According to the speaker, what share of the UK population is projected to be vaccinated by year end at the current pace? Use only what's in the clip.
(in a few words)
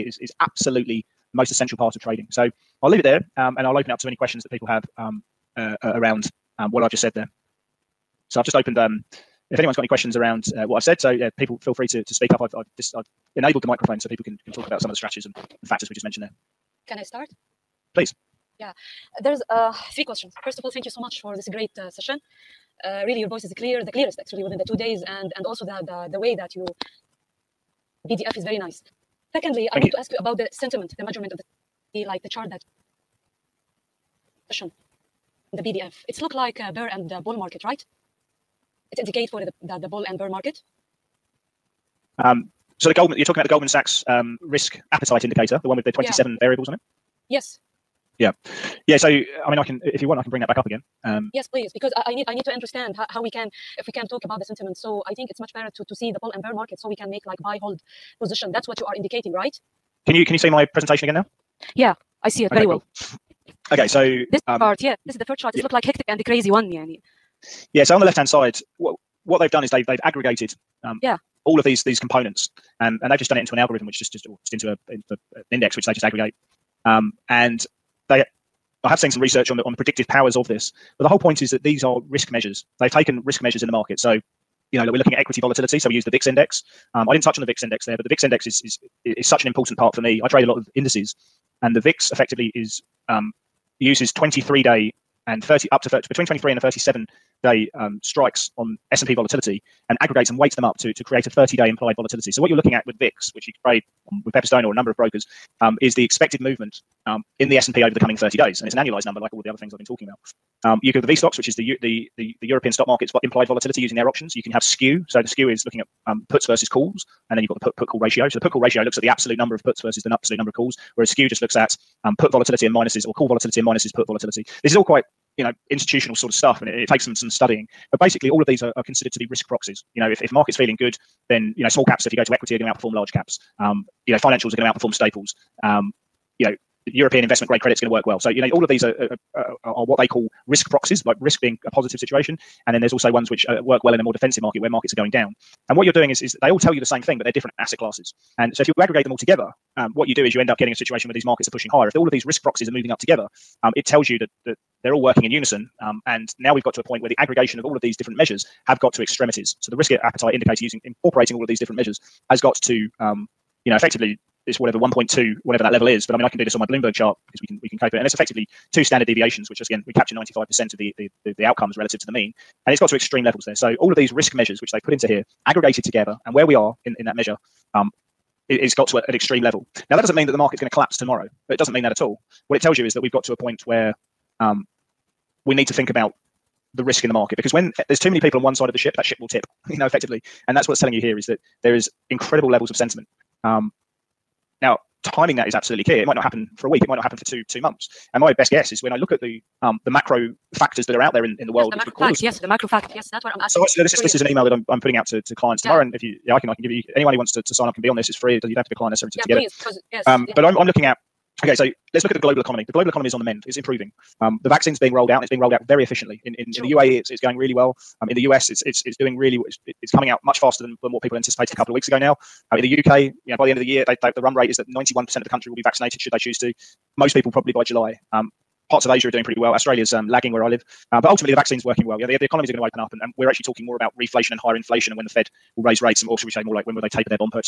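91%.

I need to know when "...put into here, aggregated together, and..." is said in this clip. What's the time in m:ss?
2:54.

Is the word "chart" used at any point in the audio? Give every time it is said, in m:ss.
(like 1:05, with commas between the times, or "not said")
0:32, 1:05, 2:46.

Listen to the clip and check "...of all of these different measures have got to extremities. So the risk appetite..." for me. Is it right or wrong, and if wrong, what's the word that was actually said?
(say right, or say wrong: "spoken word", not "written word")
right.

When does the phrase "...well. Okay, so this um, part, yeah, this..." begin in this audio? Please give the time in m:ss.
1:02.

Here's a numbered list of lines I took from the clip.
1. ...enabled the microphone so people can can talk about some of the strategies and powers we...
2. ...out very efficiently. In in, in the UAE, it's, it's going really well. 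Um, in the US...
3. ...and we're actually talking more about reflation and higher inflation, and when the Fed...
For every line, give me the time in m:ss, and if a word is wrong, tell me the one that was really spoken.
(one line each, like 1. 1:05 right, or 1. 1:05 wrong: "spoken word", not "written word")
1. 0:13 wrong: "factors", not "powers"
2. 3:35 right
3. 3:53 right.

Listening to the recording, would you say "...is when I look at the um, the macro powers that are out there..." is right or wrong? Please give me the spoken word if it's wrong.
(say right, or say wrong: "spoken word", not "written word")
wrong: "factors", not "powers".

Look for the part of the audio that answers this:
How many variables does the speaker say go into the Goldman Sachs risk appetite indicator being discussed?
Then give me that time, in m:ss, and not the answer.
0:45.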